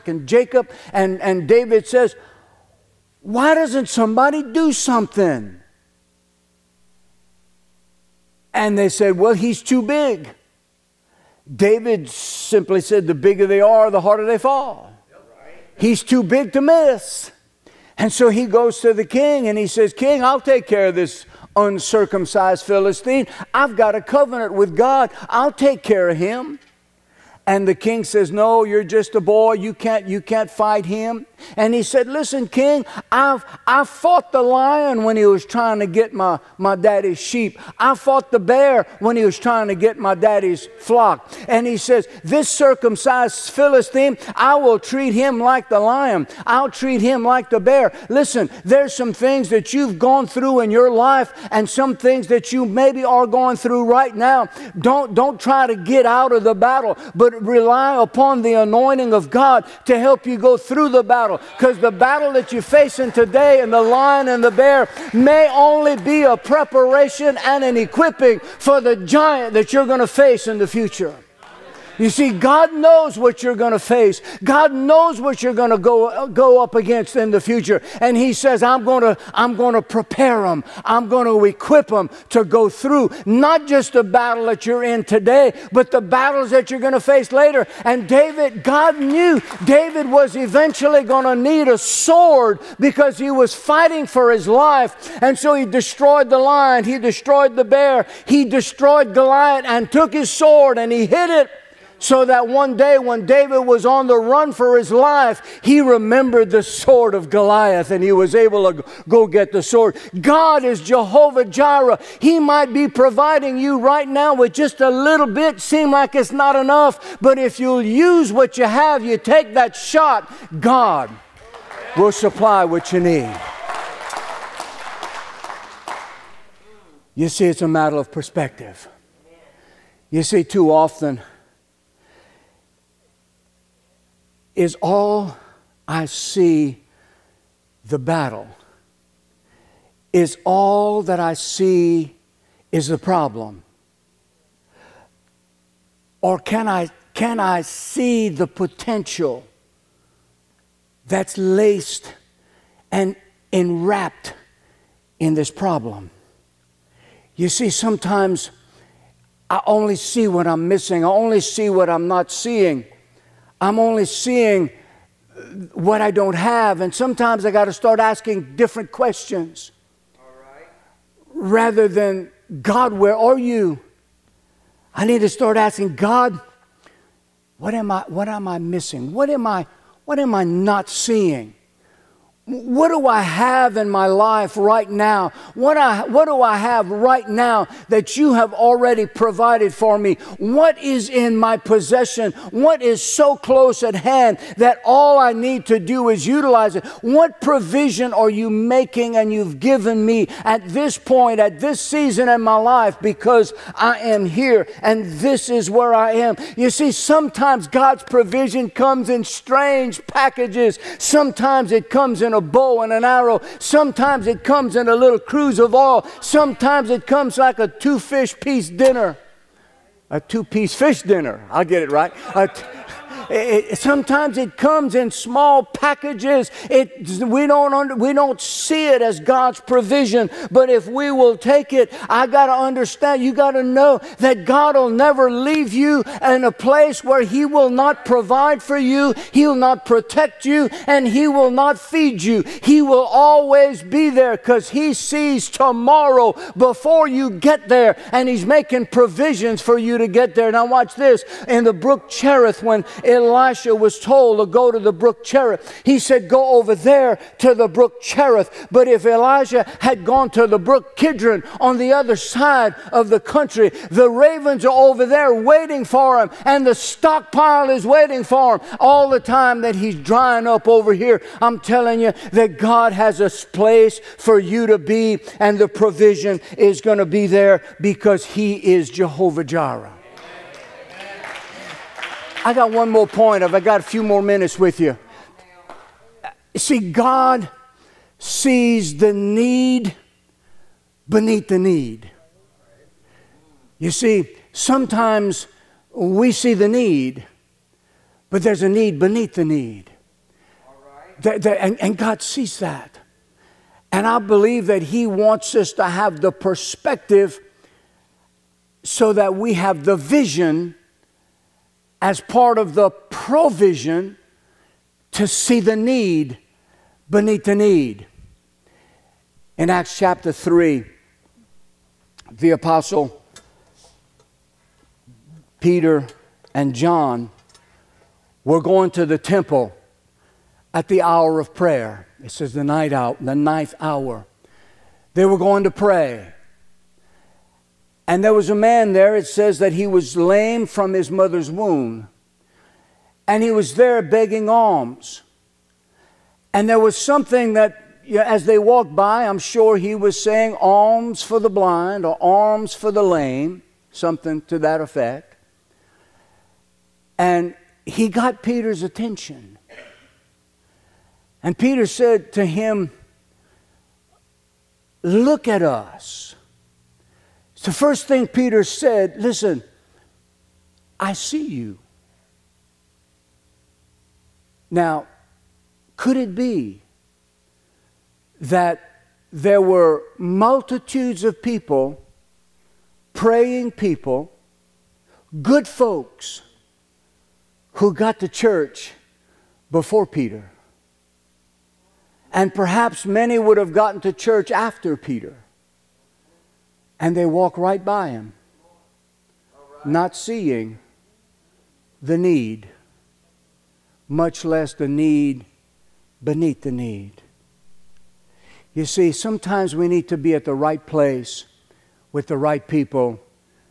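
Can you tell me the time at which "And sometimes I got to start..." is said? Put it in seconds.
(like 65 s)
166 s.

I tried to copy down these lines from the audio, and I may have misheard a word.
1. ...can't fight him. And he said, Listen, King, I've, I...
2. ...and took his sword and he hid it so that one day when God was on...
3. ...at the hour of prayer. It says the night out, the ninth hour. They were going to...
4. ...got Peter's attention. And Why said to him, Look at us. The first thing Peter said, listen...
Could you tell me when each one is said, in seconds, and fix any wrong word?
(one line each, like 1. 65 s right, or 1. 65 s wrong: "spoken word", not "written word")
1. 30 s right
2. 99 s wrong: "David", not "God"
3. 330 s right
4. 358 s wrong: "Peter", not "Why".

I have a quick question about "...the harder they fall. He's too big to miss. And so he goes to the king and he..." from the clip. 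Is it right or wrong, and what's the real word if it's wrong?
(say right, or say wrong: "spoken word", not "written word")
right.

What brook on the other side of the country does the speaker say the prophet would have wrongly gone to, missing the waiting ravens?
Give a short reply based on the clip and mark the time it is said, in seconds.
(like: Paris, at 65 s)
Kidron, at 260 s.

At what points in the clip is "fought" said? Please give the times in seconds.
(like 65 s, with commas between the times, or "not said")
33 s, 37 s.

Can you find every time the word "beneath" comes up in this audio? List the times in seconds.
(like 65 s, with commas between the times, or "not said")
291 s, 298 s, 317 s, 406 s.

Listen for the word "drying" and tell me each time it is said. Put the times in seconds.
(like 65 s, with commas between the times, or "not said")
269 s.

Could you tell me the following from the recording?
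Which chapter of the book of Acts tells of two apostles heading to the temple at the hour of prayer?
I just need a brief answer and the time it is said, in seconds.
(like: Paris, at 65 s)
Acts chapter 3, at 319 s.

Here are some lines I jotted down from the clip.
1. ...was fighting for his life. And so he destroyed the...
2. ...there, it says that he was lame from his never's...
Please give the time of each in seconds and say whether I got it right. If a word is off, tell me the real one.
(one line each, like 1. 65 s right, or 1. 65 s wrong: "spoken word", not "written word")
1. 93 s right
2. 338 s wrong: "mother", not "never".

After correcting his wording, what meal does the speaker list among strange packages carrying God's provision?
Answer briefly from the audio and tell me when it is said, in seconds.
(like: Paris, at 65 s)
two piece fish dinner, at 220 s.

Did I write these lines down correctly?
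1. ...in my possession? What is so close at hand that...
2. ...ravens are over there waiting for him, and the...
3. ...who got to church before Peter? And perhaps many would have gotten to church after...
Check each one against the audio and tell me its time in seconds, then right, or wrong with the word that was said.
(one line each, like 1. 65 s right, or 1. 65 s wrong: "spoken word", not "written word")
1. 191 s right
2. 264 s right
3. 387 s right.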